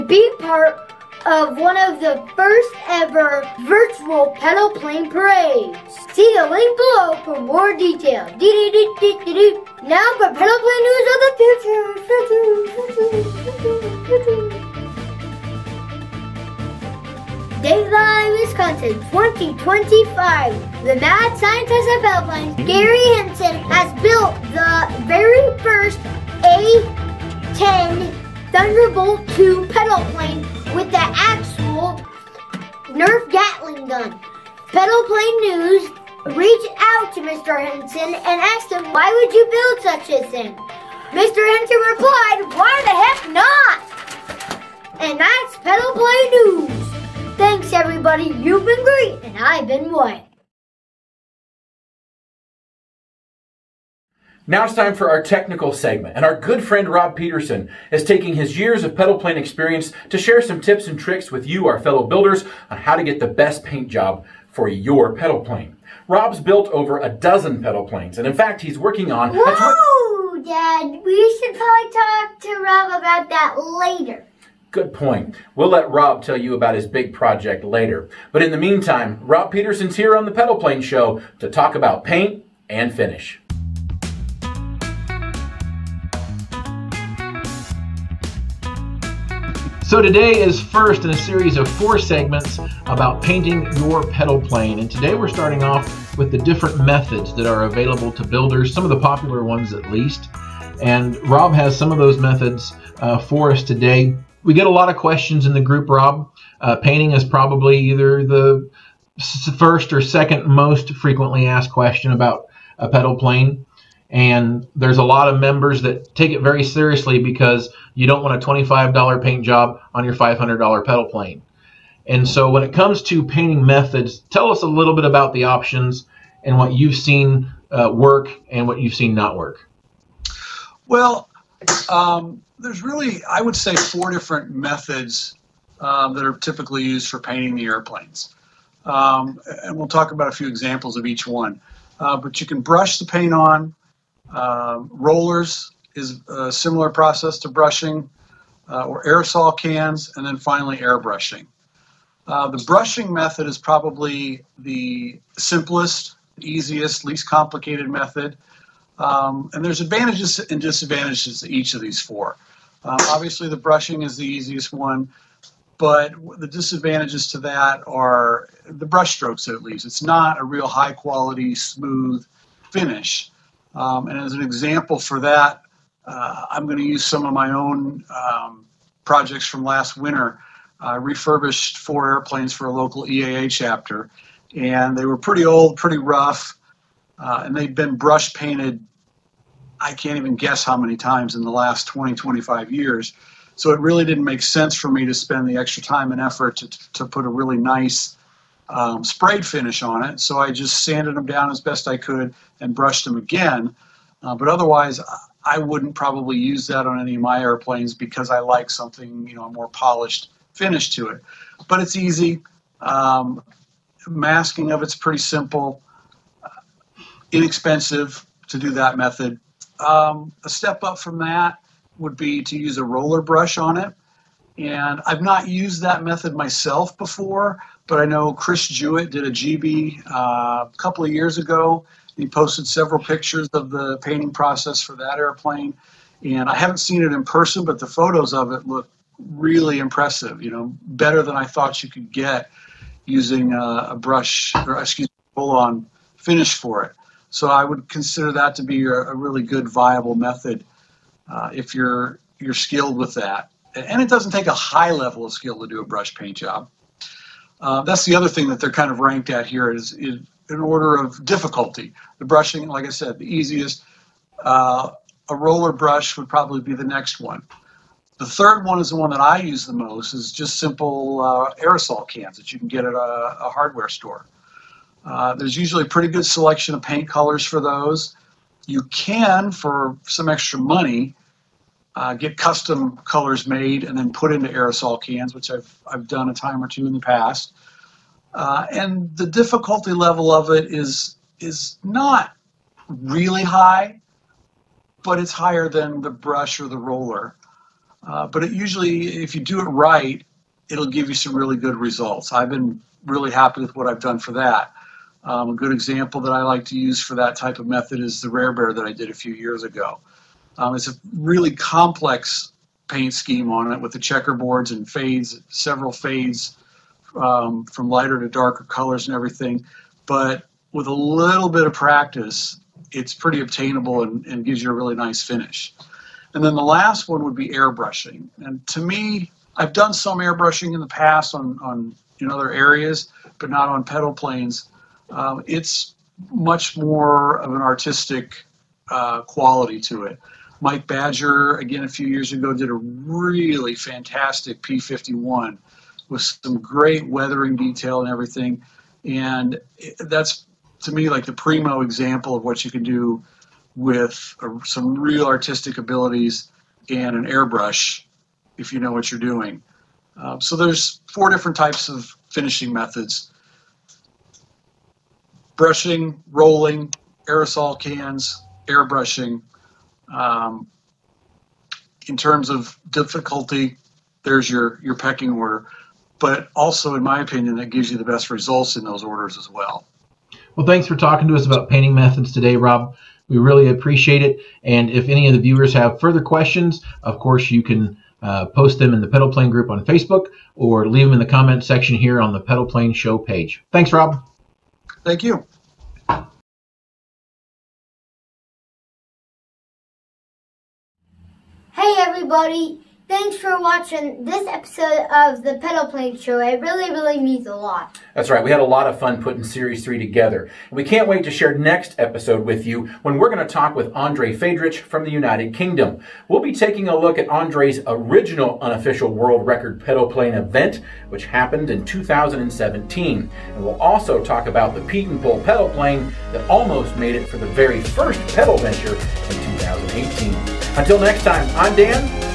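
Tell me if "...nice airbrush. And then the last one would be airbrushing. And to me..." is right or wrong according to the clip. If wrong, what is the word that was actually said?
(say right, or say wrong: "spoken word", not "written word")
wrong: "finish", not "airbrush".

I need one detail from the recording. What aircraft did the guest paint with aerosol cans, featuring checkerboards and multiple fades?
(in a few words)
Rare Bear.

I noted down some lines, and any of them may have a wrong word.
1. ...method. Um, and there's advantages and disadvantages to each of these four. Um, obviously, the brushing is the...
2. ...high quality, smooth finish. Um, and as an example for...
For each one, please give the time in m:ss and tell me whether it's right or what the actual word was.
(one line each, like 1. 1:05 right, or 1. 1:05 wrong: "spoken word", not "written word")
1. 2:37 right
2. 2:50 right.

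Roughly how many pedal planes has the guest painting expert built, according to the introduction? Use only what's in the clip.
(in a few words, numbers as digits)
Over a dozen.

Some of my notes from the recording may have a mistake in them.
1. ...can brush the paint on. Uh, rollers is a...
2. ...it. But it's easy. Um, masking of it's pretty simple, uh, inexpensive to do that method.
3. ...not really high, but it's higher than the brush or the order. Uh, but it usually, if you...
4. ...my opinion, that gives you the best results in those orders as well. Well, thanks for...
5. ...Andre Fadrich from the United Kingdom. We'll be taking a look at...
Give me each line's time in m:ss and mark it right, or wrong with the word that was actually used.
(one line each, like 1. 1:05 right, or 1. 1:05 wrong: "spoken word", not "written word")
1. 2:22 right
2. 3:31 right
3. 4:51 wrong: "roller", not "order"
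4. 6:17 right
5. 6:53 right.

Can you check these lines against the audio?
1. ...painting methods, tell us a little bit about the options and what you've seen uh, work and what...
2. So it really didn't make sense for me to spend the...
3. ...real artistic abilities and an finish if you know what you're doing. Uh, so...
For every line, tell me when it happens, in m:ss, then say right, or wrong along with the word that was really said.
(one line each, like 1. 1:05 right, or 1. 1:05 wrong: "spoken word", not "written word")
1. 2:03 right
2. 3:13 right
3. 5:54 wrong: "airbrush", not "finish".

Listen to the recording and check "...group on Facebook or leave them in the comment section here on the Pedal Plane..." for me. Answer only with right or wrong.
right.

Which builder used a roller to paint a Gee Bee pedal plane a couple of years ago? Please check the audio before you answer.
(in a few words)
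Chris Jewett.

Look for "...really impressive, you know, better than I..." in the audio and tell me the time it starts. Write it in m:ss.
3:59.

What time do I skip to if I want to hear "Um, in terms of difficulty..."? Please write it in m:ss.
6:10.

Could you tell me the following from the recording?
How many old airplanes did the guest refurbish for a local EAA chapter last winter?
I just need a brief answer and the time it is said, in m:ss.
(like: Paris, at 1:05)
4, at 3:01.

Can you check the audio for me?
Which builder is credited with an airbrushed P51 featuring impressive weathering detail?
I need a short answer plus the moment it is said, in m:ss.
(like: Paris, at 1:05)
Mike Badger, at 5:40.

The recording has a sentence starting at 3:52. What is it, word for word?
He posted several pictures of the painting process for that airplane.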